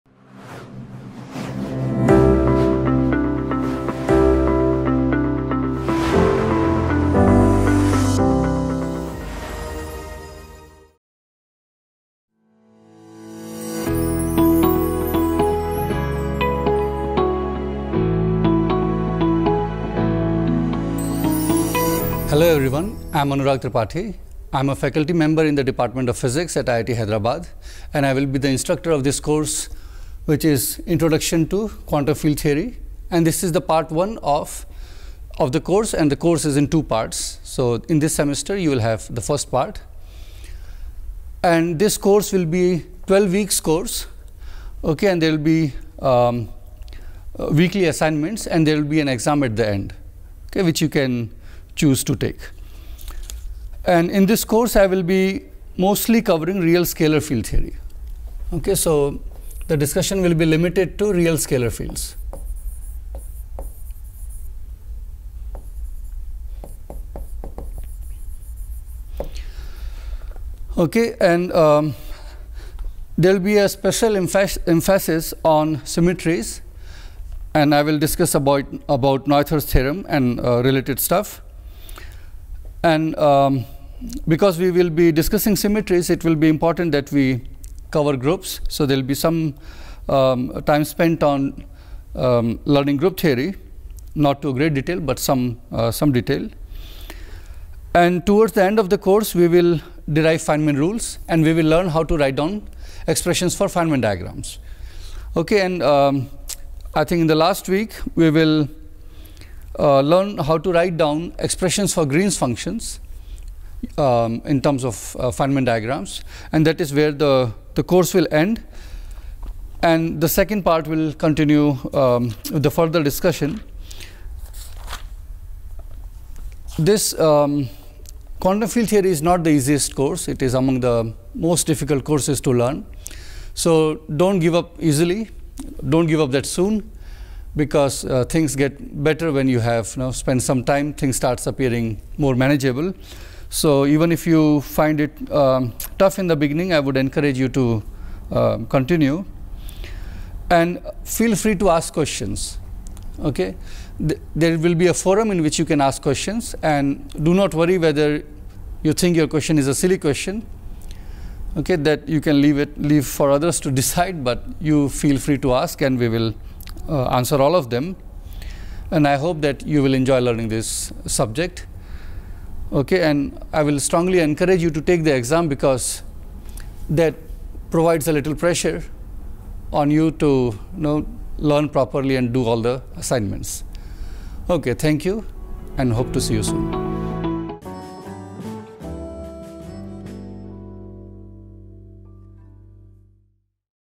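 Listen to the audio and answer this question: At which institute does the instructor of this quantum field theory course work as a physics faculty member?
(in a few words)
IIT Hyderabad.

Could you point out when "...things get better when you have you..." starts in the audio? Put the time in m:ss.
2:18.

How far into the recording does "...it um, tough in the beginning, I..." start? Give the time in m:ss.
2:25.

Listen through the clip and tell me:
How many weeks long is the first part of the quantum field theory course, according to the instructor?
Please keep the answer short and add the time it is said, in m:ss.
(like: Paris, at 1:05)
12, at 0:43.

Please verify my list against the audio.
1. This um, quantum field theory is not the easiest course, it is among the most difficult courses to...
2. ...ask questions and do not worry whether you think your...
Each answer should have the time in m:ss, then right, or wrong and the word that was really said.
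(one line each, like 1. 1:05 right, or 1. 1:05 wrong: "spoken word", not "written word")
1. 2:06 right
2. 2:35 right.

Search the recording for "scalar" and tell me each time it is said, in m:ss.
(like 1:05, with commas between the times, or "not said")
0:56, 1:01.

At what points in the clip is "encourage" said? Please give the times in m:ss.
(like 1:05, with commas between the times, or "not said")
2:26, 2:54.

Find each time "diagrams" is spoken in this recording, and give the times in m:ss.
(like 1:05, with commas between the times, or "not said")
1:44, 1:55.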